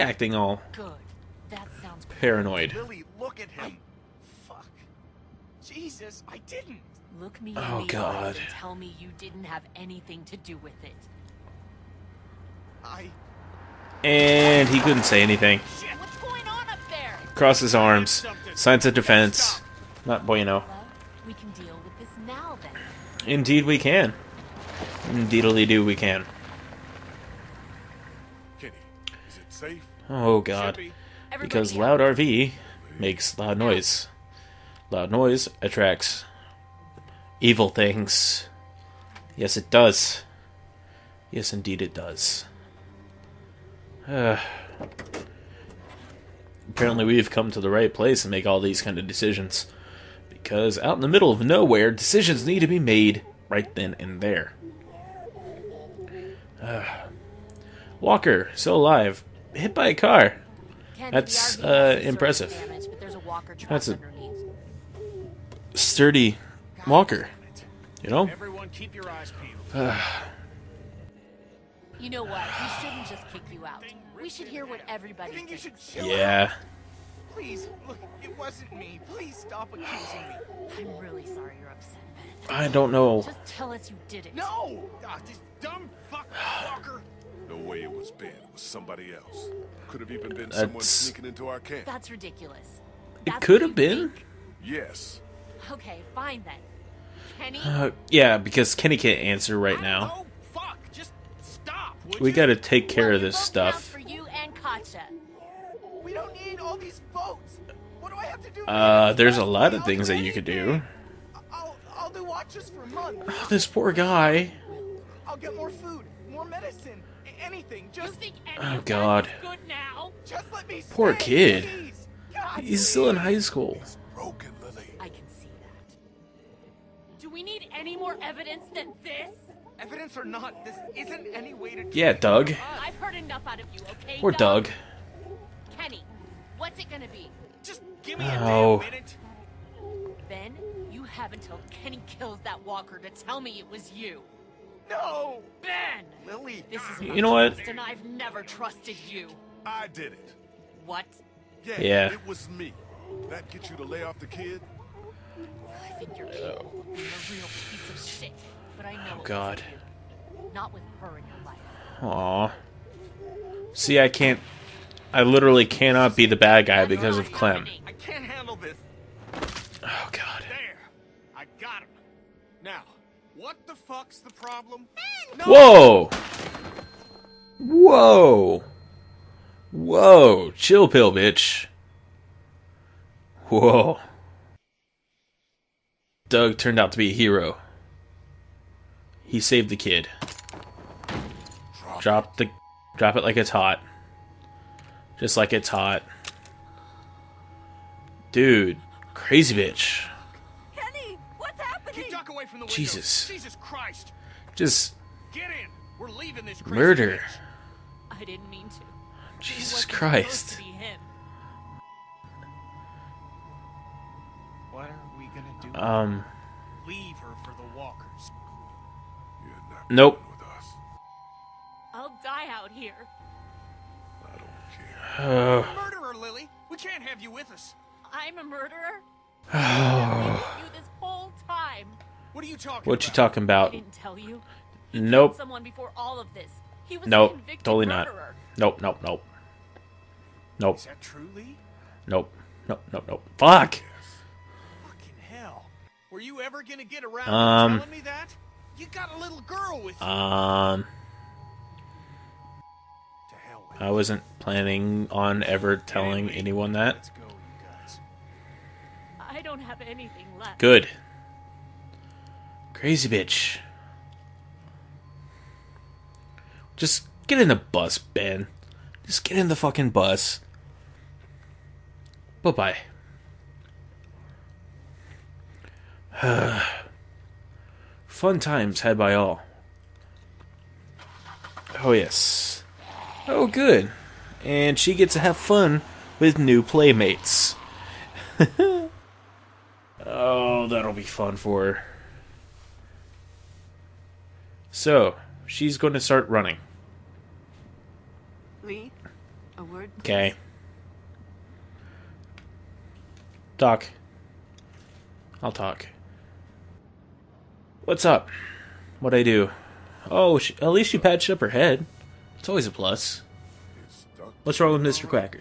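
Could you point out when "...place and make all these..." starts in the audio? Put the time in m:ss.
0:47.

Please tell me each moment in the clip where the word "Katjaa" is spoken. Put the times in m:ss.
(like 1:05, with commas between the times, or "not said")
1:44.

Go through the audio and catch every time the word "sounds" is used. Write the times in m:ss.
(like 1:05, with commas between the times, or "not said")
0:01.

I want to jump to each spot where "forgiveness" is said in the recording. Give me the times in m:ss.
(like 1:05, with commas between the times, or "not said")
not said.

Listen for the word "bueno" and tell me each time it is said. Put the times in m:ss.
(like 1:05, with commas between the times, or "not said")
0:20.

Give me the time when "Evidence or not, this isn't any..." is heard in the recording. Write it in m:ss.
2:09.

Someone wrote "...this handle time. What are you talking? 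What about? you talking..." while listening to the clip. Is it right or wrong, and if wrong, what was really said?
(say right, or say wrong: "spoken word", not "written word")
wrong: "whole", not "handle".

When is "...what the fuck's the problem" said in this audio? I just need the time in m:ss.
2:53.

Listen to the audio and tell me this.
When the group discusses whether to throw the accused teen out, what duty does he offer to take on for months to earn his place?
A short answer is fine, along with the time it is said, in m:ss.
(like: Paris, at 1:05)
watches, at 1:52.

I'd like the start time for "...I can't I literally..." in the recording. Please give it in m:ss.
2:43.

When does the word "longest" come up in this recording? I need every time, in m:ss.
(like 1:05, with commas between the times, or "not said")
not said.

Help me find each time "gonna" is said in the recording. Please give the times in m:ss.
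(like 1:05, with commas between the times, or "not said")
2:16, 4:06.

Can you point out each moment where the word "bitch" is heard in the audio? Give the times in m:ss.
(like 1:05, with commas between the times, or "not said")
3:01, 3:19, 3:28, 4:23.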